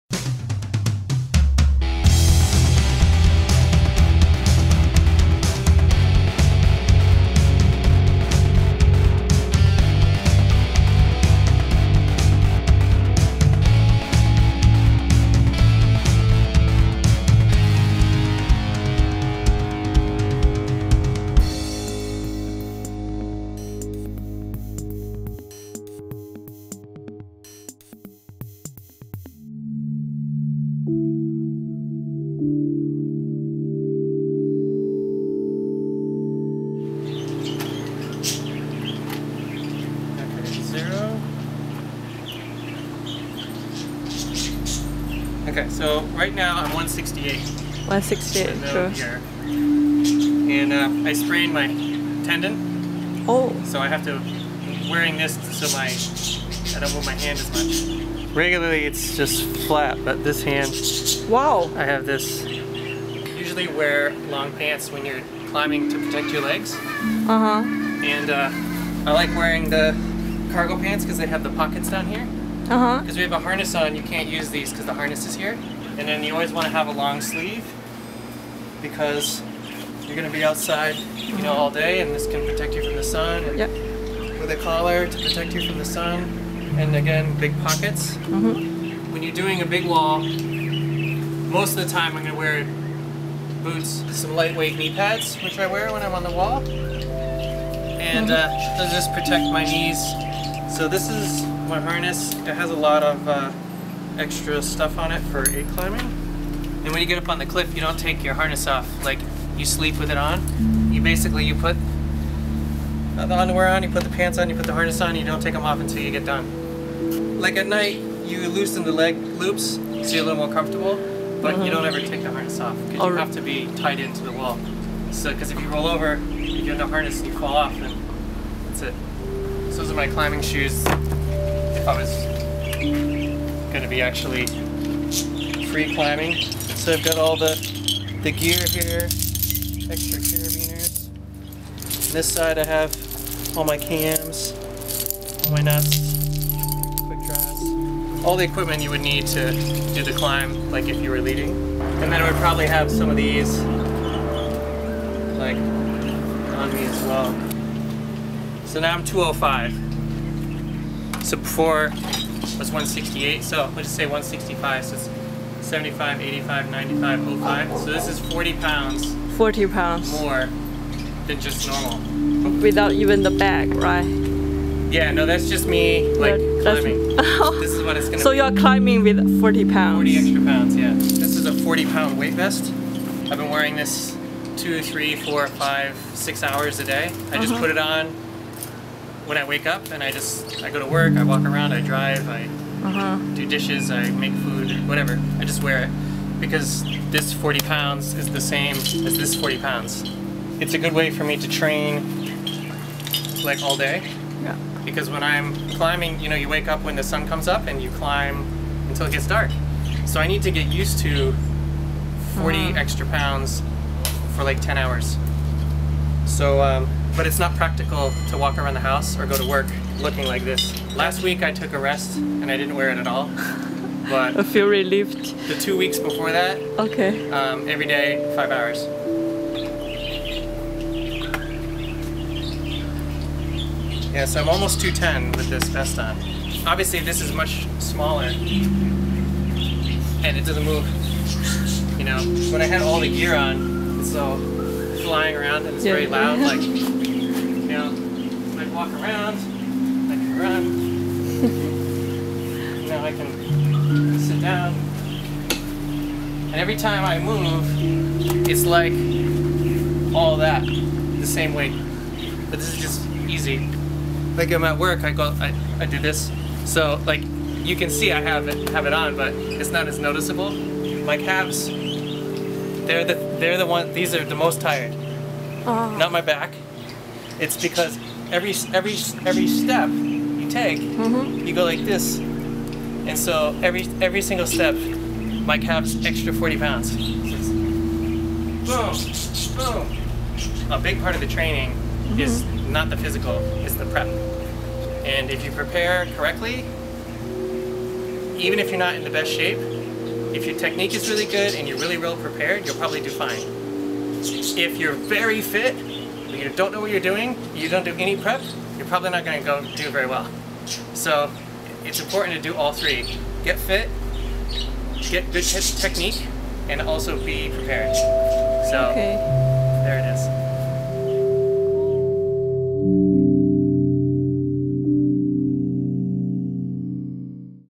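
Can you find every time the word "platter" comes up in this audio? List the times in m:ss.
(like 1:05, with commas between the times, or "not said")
not said.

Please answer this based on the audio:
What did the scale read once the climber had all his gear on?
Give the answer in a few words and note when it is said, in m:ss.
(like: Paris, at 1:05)
205, at 2:39.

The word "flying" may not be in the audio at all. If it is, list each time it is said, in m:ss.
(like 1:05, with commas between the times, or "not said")
4:05.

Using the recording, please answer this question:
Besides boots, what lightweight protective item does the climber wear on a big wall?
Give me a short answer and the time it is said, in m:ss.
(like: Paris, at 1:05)
knee pads, at 1:34.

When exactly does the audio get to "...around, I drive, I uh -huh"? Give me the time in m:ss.
3:11.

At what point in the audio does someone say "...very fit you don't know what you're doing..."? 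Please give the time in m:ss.
5:04.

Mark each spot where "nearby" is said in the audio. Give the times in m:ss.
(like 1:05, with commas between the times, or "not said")
not said.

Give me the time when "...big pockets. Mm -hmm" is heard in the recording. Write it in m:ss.
1:27.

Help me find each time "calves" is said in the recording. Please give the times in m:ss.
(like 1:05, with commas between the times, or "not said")
4:31, 4:45.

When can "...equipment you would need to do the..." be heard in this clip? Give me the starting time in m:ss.
2:28.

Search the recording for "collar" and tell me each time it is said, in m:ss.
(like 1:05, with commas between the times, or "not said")
1:24.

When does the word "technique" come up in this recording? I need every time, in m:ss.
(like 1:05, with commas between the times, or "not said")
5:00, 5:15.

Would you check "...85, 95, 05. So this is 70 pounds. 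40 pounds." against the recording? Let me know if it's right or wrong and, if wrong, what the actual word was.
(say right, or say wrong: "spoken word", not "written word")
wrong: "40", not "70".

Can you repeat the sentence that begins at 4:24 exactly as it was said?
Like I'm at work, I go, I, I do this.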